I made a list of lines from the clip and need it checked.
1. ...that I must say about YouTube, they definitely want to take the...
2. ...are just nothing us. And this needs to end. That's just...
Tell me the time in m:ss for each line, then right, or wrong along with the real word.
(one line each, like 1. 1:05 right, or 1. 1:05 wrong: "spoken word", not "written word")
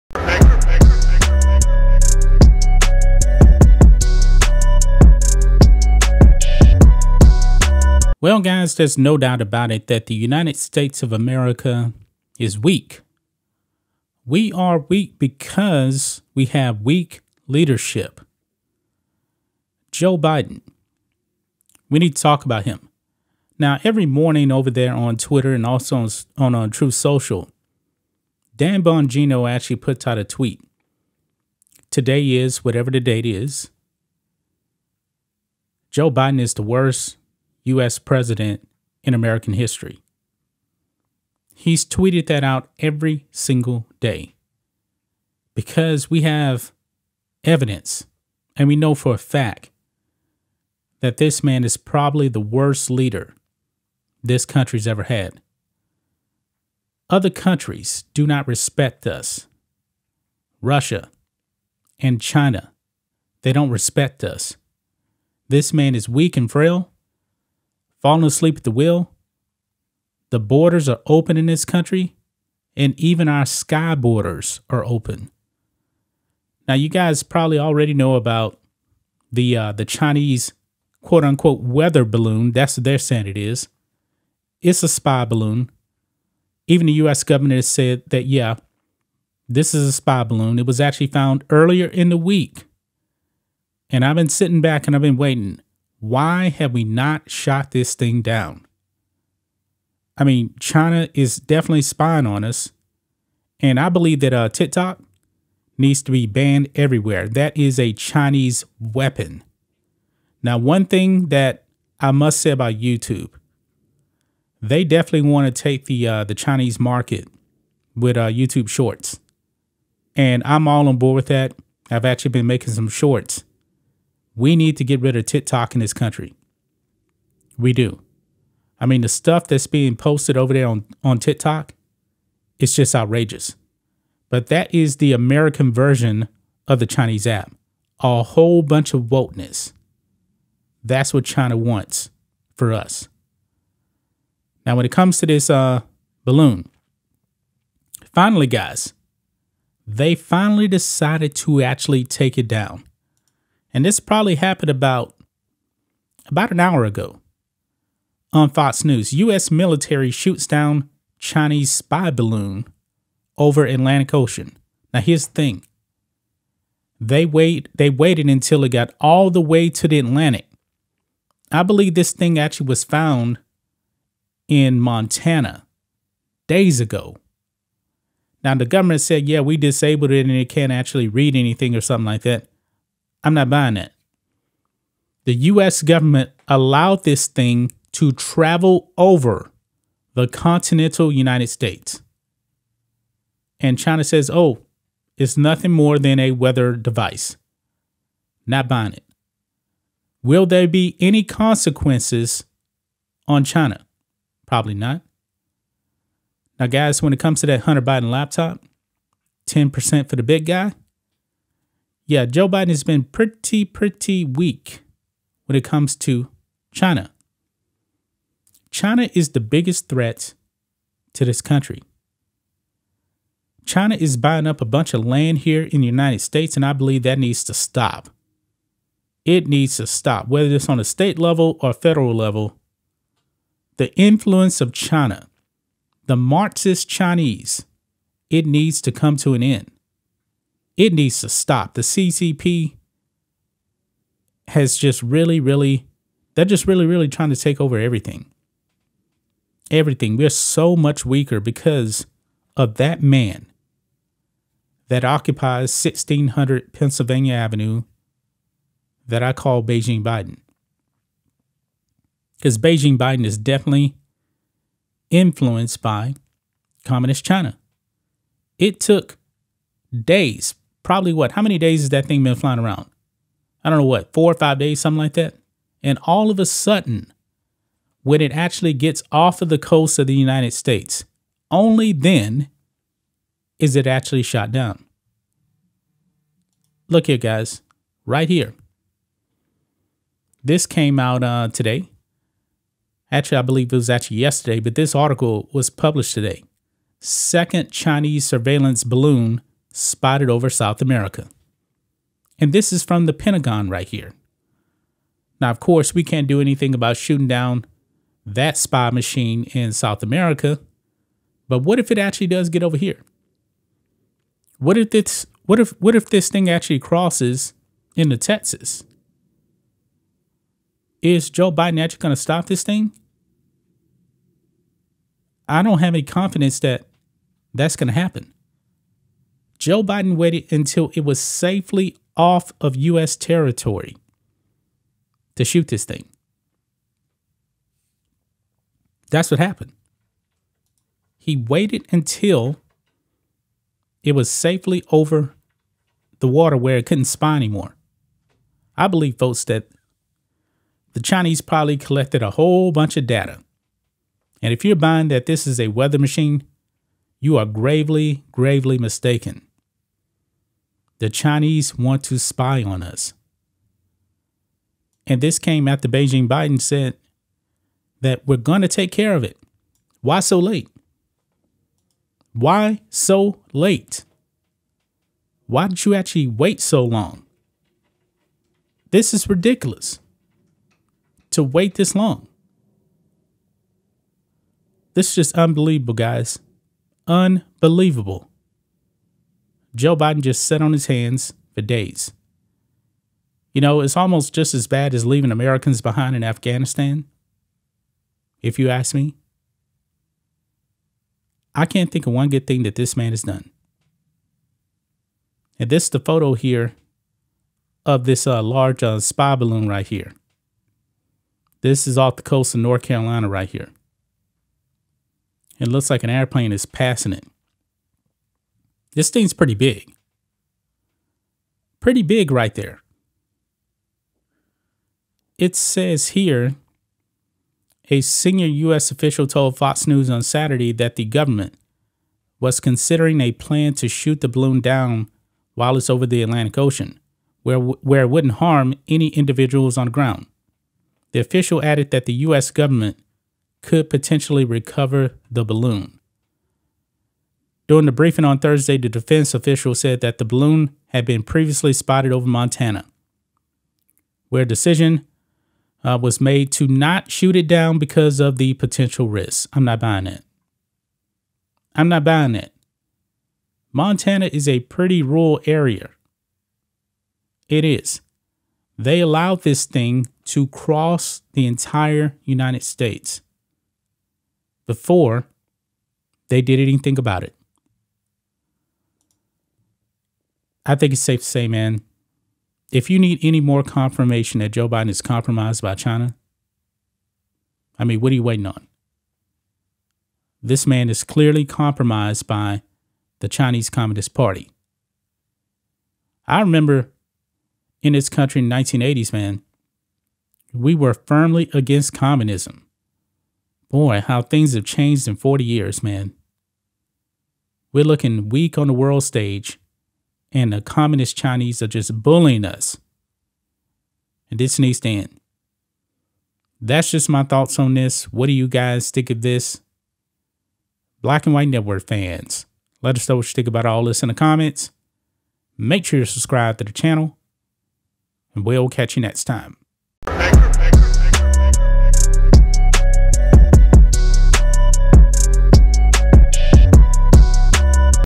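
1. 1:51 right
2. 8:31 wrong: "bullying", not "nothing".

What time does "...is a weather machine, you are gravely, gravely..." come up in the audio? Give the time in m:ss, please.
5:55.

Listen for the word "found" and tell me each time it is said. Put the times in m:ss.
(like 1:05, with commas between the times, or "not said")
1:31, 2:52.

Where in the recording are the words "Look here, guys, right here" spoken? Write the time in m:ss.
4:46.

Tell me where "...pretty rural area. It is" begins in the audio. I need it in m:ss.
7:44.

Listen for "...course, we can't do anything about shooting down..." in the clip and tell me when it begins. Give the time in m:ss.
5:05.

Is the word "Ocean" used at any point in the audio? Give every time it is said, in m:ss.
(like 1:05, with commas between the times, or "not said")
2:44, 7:16.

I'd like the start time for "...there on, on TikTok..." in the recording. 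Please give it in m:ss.
2:10.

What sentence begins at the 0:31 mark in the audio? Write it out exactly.
Today is whatever the date is.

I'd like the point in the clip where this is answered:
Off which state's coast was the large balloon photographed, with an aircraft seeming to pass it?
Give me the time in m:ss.
6:52.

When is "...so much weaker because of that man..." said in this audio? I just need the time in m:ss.
4:10.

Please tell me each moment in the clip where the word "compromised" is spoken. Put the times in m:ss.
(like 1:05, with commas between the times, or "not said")
8:05, 8:11.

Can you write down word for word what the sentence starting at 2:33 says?
And this probably happened about about an hour ago on Fox News.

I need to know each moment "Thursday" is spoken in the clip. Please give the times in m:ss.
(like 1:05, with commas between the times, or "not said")
7:28.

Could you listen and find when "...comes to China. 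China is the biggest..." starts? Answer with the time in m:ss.
3:35.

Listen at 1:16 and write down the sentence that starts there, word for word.
Now, you guys probably already know about the uh, the Chinese quote unquote weather balloon.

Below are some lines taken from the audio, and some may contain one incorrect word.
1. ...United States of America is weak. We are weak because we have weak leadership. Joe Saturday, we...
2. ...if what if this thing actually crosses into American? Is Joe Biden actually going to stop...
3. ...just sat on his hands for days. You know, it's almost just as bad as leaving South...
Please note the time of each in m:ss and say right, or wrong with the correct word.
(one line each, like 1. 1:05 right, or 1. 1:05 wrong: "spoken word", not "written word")
1. 0:10 wrong: "Biden", not "Saturday"
2. 5:15 wrong: "Texas", not "American"
3. 6:30 wrong: "Americans", not "South".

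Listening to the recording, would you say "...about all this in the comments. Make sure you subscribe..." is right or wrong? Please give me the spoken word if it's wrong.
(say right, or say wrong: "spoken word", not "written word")
right.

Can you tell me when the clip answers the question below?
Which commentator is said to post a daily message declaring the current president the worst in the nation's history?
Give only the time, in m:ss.
0:28.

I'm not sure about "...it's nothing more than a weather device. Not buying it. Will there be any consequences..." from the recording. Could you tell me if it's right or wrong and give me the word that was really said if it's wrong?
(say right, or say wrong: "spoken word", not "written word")
right.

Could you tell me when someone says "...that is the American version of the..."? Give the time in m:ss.
2:14.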